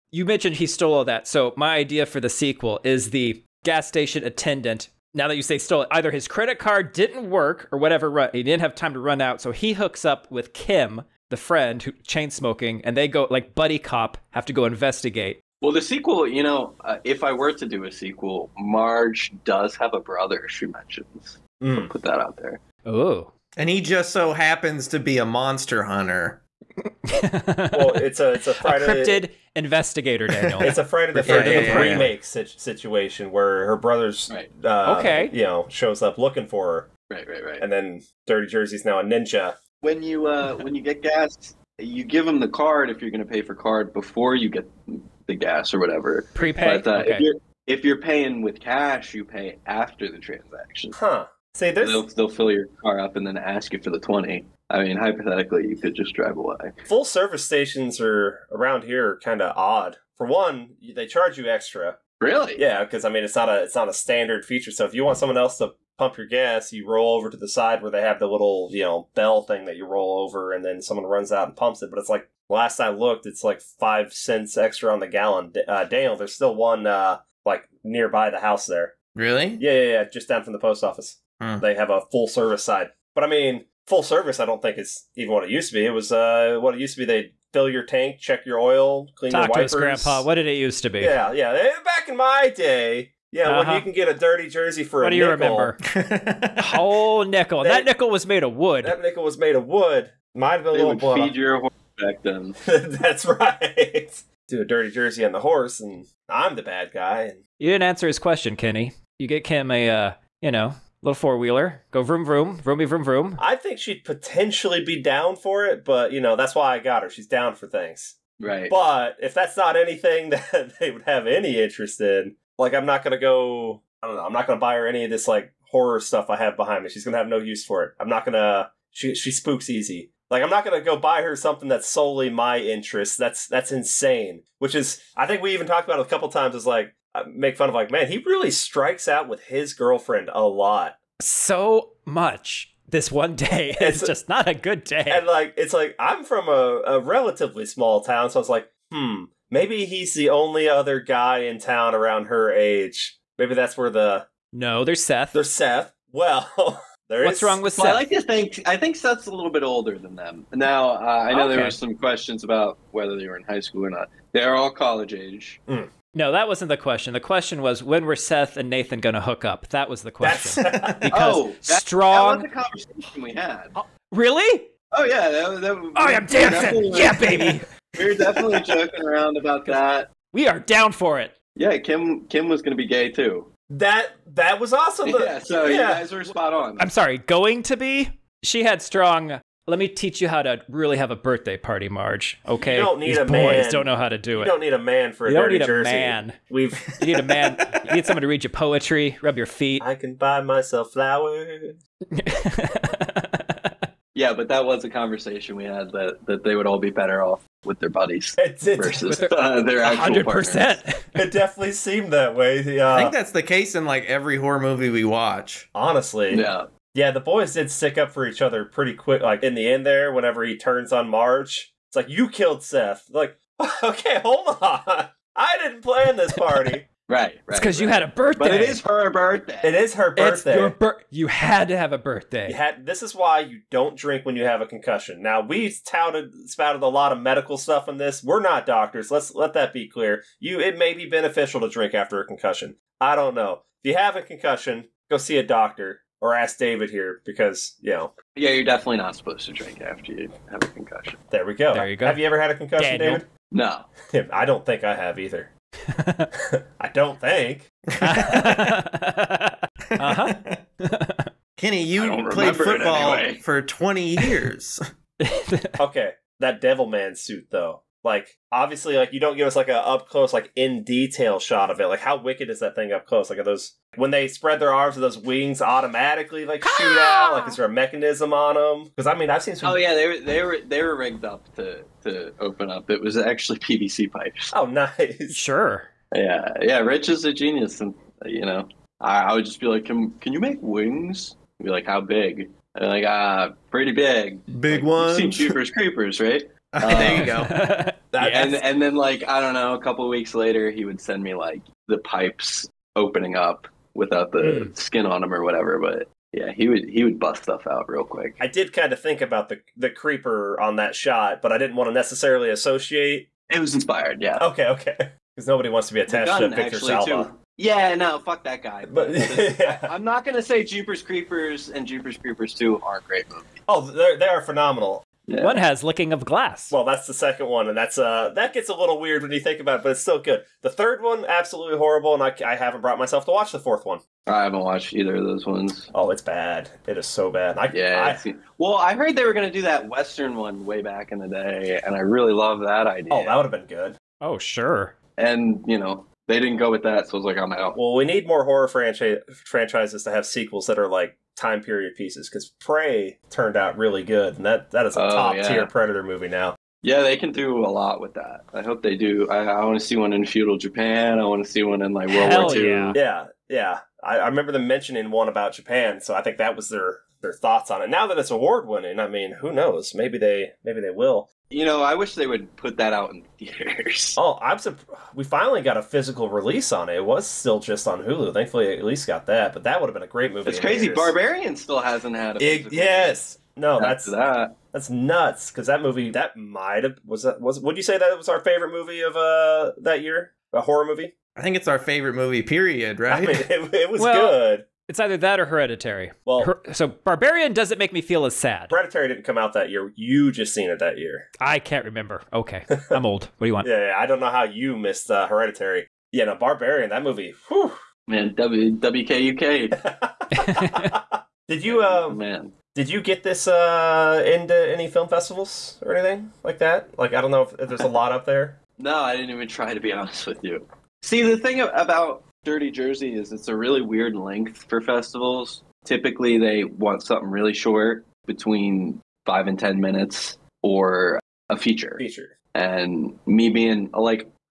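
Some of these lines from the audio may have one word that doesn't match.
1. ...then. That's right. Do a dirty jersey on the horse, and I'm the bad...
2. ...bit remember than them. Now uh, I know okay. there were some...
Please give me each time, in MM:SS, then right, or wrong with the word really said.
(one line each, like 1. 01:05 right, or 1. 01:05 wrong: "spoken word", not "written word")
1. 01:42 right
2. 02:39 wrong: "older", not "remember".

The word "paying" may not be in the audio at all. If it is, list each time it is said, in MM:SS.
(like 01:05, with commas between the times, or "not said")
00:48.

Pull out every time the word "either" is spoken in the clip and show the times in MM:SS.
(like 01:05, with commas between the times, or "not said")
00:05, 04:15, 05:34, 06:34.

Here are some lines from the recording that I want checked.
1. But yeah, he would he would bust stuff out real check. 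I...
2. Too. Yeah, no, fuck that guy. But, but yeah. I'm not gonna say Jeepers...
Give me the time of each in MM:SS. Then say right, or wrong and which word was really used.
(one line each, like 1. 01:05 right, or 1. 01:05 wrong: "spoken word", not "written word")
1. 05:05 wrong: "quick", not "check"
2. 05:17 right.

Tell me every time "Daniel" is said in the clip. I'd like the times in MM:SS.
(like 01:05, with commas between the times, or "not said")
00:30, 01:15, 04:12.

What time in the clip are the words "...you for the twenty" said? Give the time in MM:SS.
00:53.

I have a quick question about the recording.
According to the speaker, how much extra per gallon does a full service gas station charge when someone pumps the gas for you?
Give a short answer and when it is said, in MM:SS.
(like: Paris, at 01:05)
5 cents, at 01:13.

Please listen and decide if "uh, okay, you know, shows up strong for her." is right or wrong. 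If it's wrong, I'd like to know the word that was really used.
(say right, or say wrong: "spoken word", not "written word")
wrong: "looking", not "strong".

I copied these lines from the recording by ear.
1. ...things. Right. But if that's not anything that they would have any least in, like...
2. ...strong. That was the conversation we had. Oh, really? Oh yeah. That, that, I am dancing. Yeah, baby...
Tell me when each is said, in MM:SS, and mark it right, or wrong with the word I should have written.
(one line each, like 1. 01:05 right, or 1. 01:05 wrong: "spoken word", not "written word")
1. 01:57 wrong: "interest", not "least"
2. 02:51 right.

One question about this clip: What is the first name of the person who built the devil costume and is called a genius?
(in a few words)
Rich.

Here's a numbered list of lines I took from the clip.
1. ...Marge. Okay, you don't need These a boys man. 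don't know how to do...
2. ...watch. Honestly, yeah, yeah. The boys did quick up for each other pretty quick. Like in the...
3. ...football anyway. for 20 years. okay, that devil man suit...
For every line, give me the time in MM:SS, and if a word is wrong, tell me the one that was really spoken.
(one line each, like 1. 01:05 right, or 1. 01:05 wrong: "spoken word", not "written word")
1. 03:11 right
2. 03:35 wrong: "stick", not "quick"
3. 04:22 right.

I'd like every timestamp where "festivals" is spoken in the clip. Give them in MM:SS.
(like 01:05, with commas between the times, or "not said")
06:55, 07:04.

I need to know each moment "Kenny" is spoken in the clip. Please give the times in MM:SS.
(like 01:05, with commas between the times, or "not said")
01:48, 04:21.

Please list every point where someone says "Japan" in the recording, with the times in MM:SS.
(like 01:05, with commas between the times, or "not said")
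06:00, 06:05.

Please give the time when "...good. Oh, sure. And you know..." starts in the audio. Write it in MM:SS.
05:43.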